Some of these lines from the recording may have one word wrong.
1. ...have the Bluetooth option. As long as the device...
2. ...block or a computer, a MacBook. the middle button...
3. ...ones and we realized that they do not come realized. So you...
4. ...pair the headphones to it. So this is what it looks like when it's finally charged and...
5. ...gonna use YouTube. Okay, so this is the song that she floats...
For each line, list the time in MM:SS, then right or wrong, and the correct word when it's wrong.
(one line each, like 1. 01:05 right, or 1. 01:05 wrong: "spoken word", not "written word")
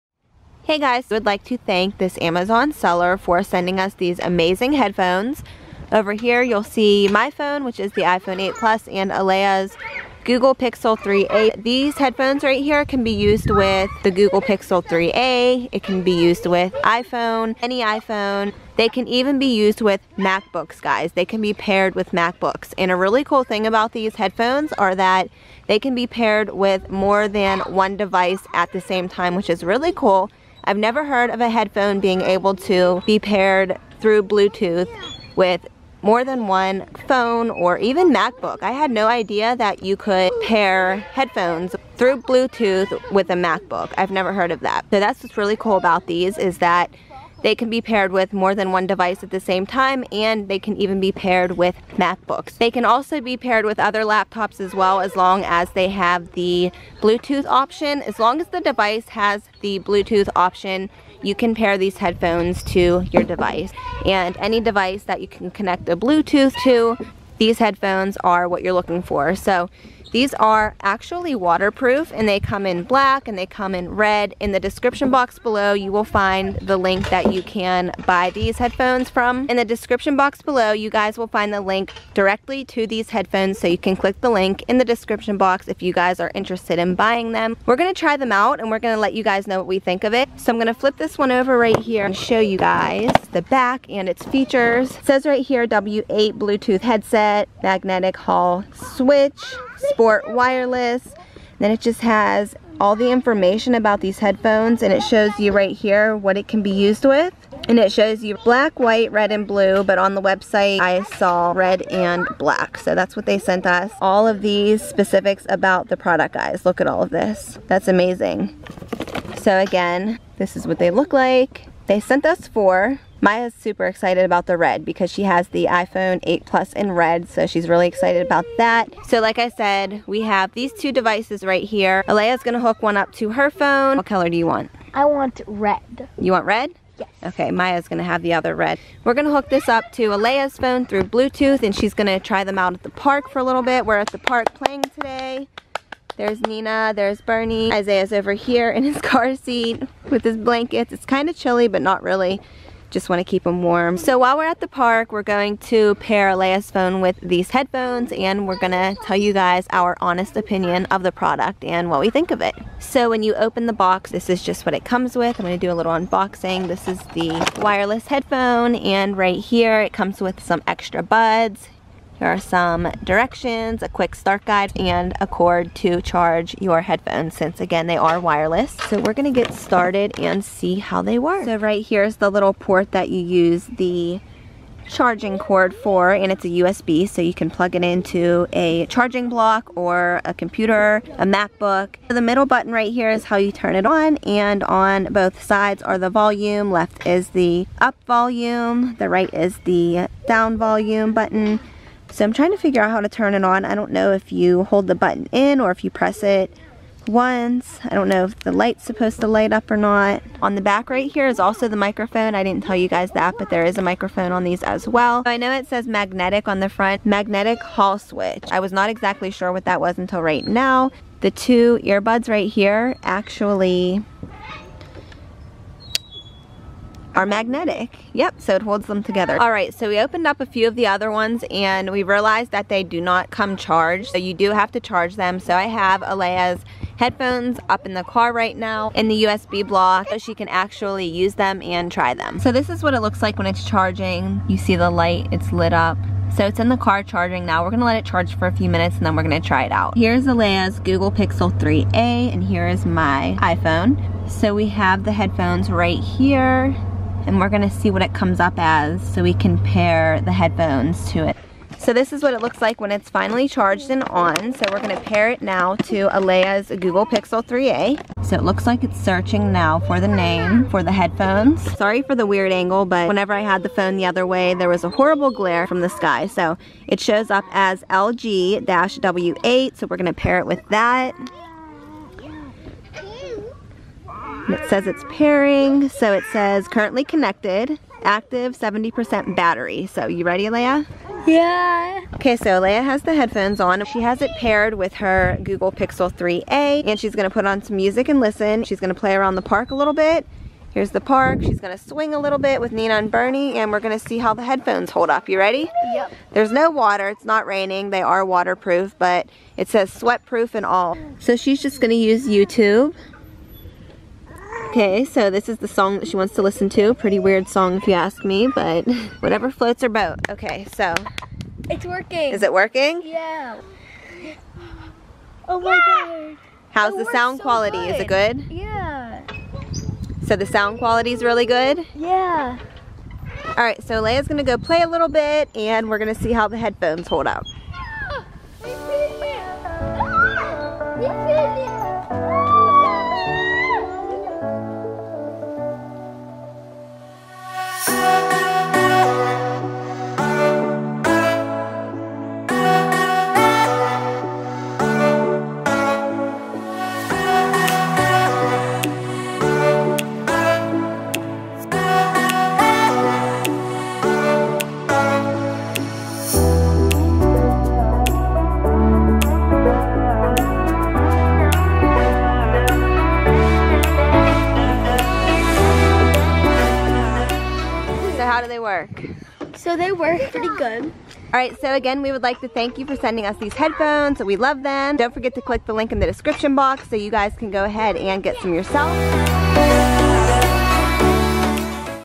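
1. 00:55 right
2. 03:09 right
3. 03:51 wrong: "charged", not "realized"
4. 04:19 right
5. 05:11 wrong: "wants", not "floats".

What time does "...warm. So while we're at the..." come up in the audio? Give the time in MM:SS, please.
02:33.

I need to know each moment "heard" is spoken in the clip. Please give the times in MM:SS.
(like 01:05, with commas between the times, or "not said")
00:31, 00:44.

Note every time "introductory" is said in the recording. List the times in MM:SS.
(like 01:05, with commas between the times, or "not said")
not said.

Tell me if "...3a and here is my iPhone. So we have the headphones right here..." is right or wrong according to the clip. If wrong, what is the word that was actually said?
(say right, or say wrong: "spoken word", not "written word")
right.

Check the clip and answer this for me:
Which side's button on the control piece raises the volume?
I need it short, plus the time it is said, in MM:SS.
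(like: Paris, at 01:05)
Left, at 03:16.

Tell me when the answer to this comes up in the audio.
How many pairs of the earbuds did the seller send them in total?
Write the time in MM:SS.
02:02.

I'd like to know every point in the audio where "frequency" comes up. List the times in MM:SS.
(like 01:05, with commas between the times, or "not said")
not said.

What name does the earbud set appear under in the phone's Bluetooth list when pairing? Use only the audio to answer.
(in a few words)
LG-W8.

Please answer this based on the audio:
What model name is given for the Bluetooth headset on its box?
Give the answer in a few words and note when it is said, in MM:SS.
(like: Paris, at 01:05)
W8, at 01:35.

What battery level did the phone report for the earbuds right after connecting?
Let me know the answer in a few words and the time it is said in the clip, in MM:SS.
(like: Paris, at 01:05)
70%, at 04:48.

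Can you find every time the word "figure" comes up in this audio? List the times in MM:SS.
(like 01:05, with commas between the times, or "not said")
03:22.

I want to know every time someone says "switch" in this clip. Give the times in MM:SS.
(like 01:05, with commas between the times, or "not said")
01:38, 03:37.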